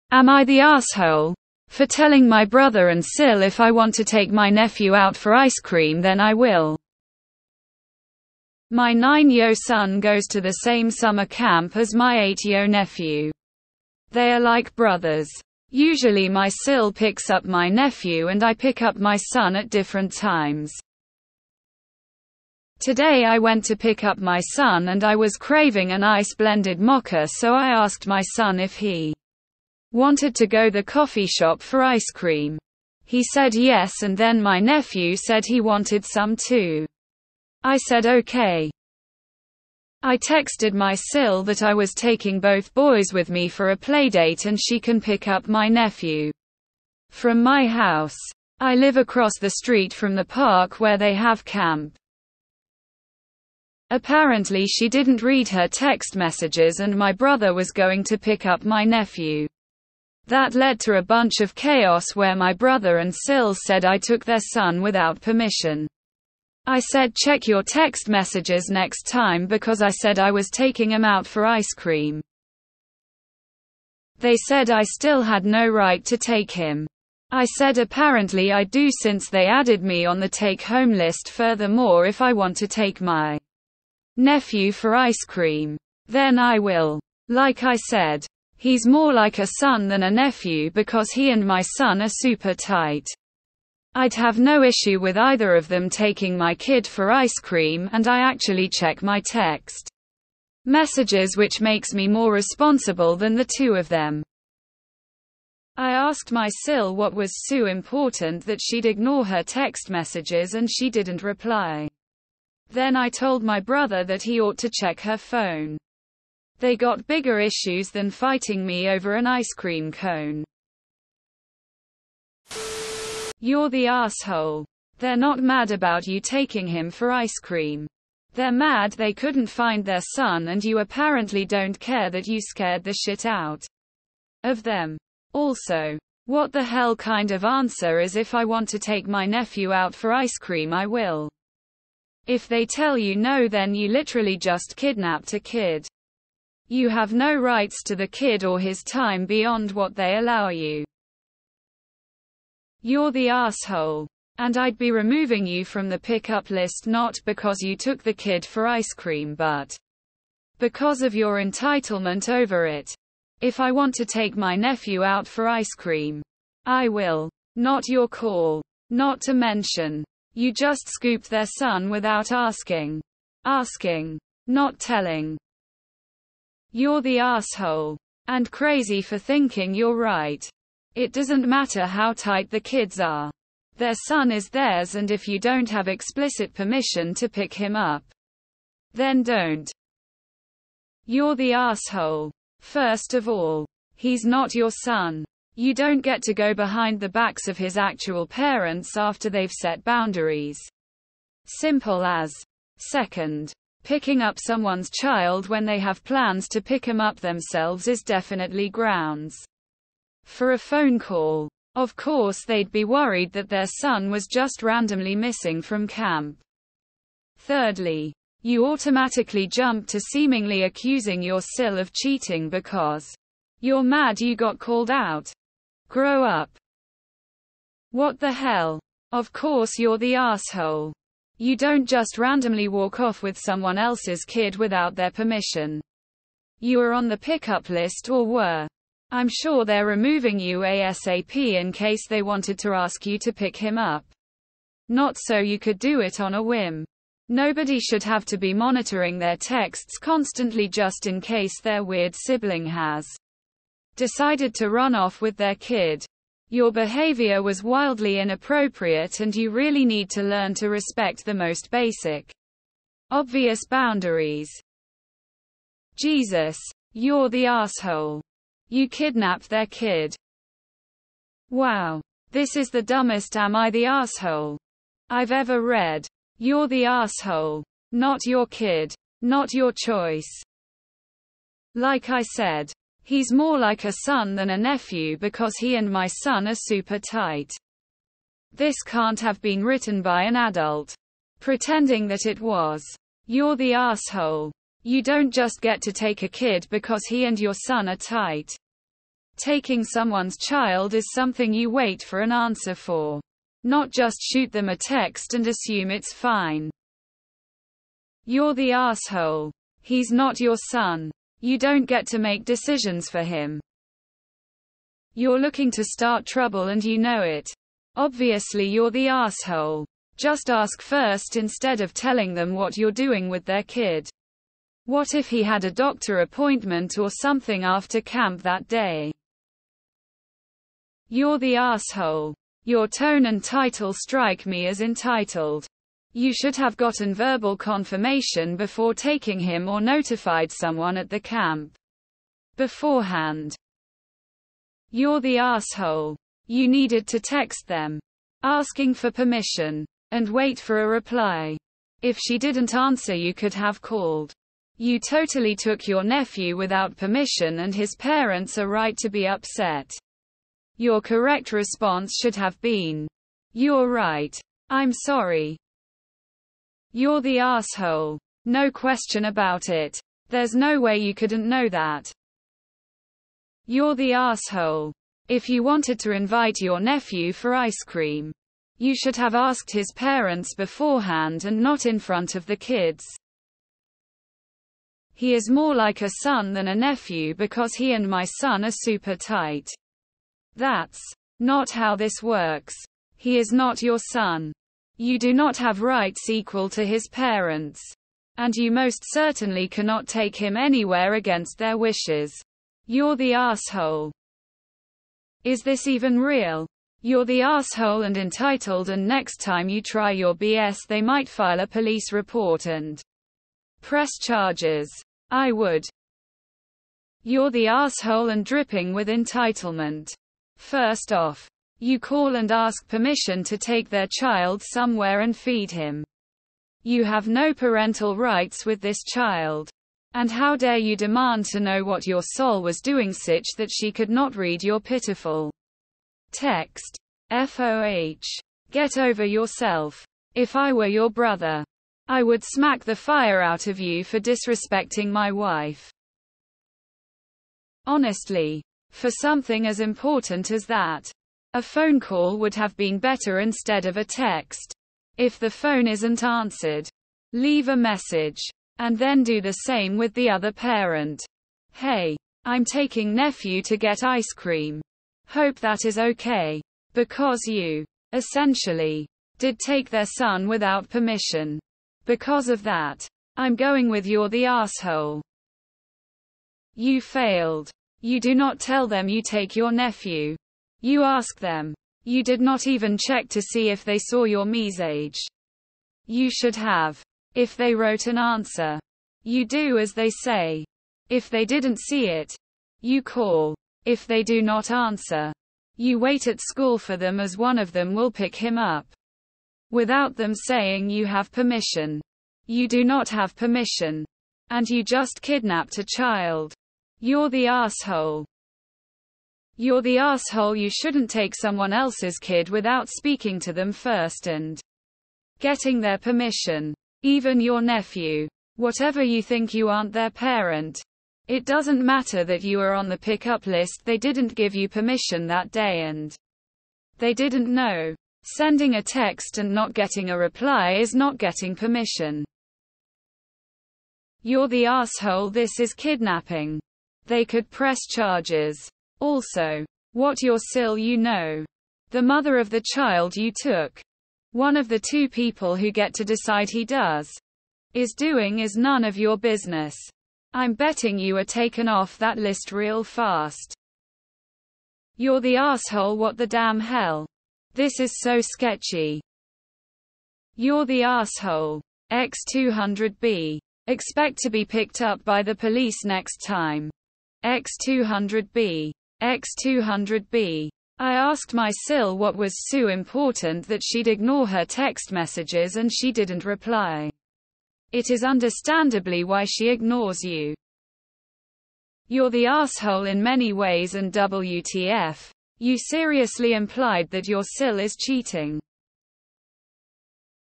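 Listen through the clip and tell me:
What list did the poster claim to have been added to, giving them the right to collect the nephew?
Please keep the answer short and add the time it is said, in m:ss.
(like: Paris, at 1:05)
take home list, at 1:20.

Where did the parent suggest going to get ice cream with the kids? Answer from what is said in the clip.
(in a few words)
coffee shop.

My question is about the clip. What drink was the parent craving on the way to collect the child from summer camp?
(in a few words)
ice blended mocha.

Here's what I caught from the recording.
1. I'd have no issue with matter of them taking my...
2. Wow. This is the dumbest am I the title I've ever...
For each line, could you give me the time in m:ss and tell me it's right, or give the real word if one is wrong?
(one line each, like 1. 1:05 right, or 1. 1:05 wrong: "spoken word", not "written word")
1. 1:33 wrong: "either", not "matter"
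2. 4:31 wrong: "asshole", not "title".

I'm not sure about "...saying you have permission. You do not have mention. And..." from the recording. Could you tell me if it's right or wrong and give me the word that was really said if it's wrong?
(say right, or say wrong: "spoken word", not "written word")
wrong: "permission", not "mention".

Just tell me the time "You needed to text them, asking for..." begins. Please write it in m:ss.
5:46.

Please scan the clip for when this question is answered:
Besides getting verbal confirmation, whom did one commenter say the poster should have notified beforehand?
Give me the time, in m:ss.
5:40.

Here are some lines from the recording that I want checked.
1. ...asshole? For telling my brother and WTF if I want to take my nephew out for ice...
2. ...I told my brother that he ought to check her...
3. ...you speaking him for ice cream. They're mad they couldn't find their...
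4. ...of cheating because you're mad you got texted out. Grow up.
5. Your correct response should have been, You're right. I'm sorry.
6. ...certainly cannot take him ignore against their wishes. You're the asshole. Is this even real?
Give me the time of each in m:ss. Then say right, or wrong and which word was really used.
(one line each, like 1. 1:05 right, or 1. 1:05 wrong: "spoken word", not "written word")
1. 0:00 wrong: "Sil", not "WTF"
2. 1:52 right
3. 2:06 wrong: "taking", not "speaking"
4. 3:41 wrong: "called", not "texted"
5. 6:00 right
6. 6:39 wrong: "anywhere", not "ignore".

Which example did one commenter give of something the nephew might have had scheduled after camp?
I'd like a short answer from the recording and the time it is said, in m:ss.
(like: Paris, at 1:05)
doctor appointment, at 5:25.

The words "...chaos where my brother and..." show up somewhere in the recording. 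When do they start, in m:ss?
1:01.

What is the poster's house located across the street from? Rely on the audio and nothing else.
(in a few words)
the park.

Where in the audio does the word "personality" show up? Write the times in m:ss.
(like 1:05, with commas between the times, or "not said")
not said.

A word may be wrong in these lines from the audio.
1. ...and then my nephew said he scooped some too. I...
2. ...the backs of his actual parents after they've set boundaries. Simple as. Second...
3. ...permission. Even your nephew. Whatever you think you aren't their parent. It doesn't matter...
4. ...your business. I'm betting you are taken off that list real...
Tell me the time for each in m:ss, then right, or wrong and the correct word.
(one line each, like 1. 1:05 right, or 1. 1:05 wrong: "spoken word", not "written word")
1. 0:34 wrong: "wanted", not "scooped"
2. 3:17 right
3. 8:35 right
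4. 9:08 right.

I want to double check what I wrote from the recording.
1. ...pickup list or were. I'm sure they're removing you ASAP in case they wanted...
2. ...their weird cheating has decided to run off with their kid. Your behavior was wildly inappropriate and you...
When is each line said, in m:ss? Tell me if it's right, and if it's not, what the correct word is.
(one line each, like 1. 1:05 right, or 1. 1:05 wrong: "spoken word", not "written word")
1. 3:57 right
2. 4:11 wrong: "sibling", not "cheating".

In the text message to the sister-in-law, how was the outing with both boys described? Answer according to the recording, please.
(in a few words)
playdate.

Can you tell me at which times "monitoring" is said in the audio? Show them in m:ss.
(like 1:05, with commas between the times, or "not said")
4:08.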